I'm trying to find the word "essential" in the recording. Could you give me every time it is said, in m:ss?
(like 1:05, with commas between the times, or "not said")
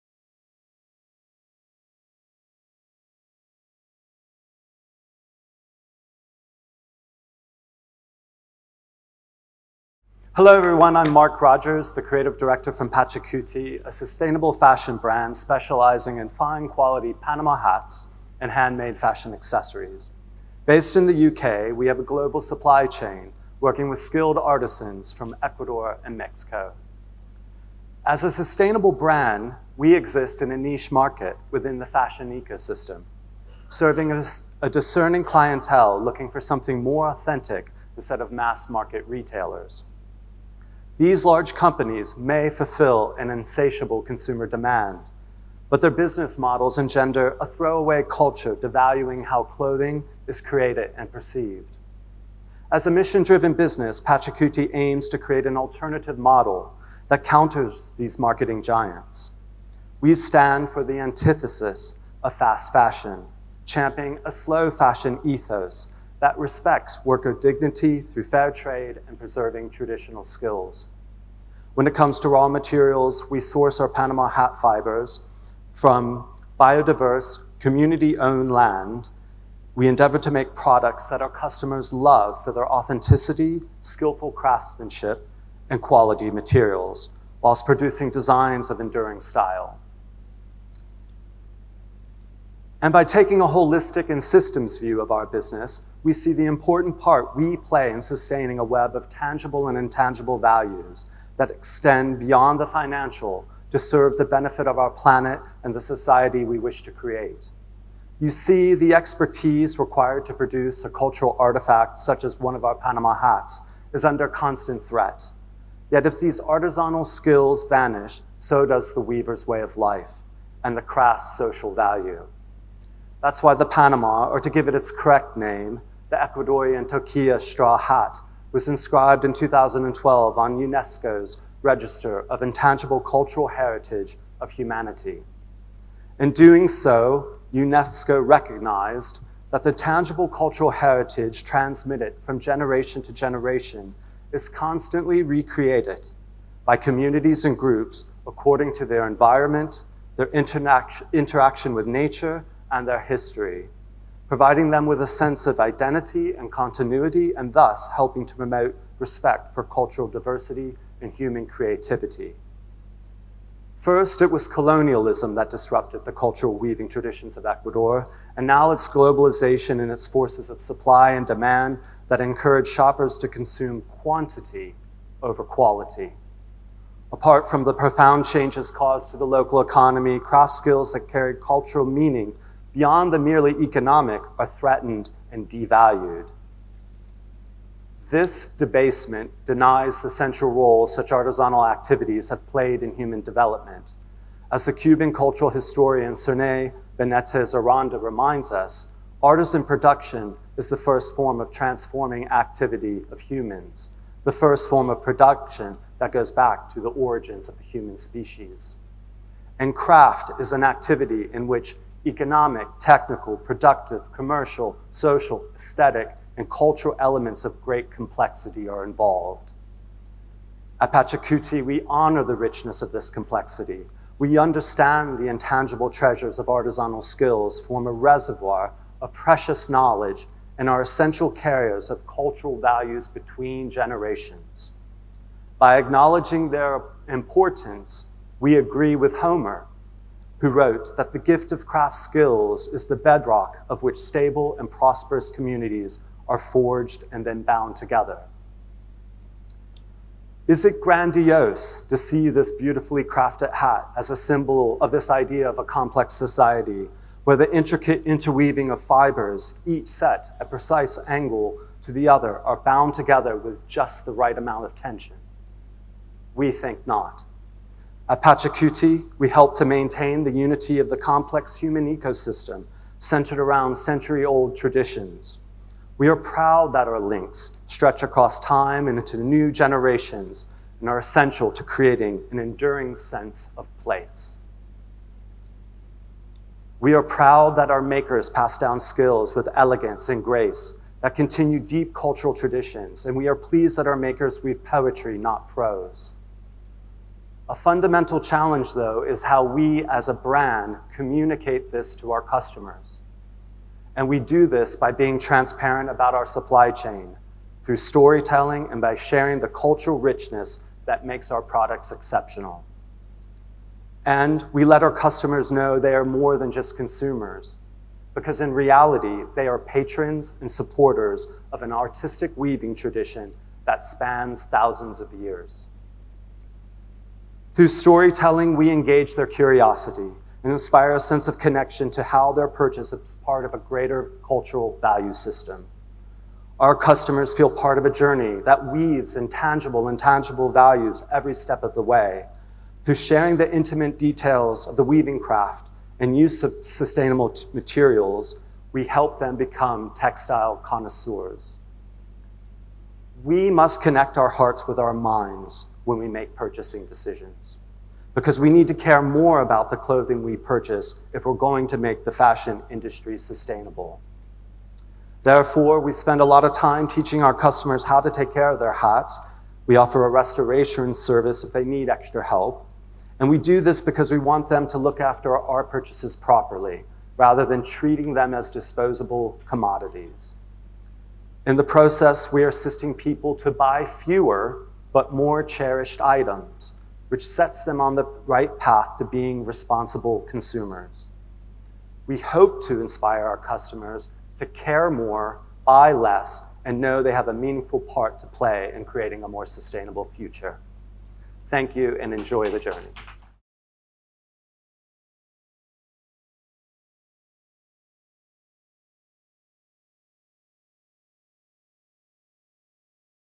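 3:50, 4:40.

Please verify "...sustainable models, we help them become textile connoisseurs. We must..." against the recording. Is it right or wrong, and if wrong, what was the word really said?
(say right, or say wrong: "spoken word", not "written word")
wrong: "materials", not "models".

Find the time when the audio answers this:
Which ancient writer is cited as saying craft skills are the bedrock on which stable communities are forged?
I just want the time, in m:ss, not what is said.
3:59.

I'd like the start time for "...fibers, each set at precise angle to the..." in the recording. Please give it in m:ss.
4:18.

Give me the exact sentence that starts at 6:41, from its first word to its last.
Thank you and enjoy the journey.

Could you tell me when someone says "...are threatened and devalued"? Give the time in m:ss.
3:04.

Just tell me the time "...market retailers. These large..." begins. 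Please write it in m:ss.
0:38.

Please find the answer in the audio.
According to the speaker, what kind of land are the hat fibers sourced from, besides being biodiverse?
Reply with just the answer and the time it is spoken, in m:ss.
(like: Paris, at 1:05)
Community-owned land, at 1:17.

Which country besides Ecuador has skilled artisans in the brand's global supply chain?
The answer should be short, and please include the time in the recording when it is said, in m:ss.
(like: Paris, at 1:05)
Mexico, at 0:26.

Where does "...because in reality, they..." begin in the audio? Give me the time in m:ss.
5:18.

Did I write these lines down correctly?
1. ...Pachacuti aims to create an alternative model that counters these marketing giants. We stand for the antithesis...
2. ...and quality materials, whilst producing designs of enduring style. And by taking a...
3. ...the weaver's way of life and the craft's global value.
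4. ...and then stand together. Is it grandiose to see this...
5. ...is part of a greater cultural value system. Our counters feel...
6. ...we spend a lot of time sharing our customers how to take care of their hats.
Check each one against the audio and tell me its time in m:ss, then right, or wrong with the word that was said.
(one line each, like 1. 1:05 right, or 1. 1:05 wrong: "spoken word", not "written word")
1. 0:53 right
2. 1:25 right
3. 1:58 wrong: "social", not "global"
4. 4:07 wrong: "bound", not "stand"
5. 5:32 wrong: "customers", not "counters"
6. 6:05 wrong: "teaching", not "sharing".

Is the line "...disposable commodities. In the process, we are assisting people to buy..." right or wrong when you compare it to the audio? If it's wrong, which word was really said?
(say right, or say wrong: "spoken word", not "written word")
right.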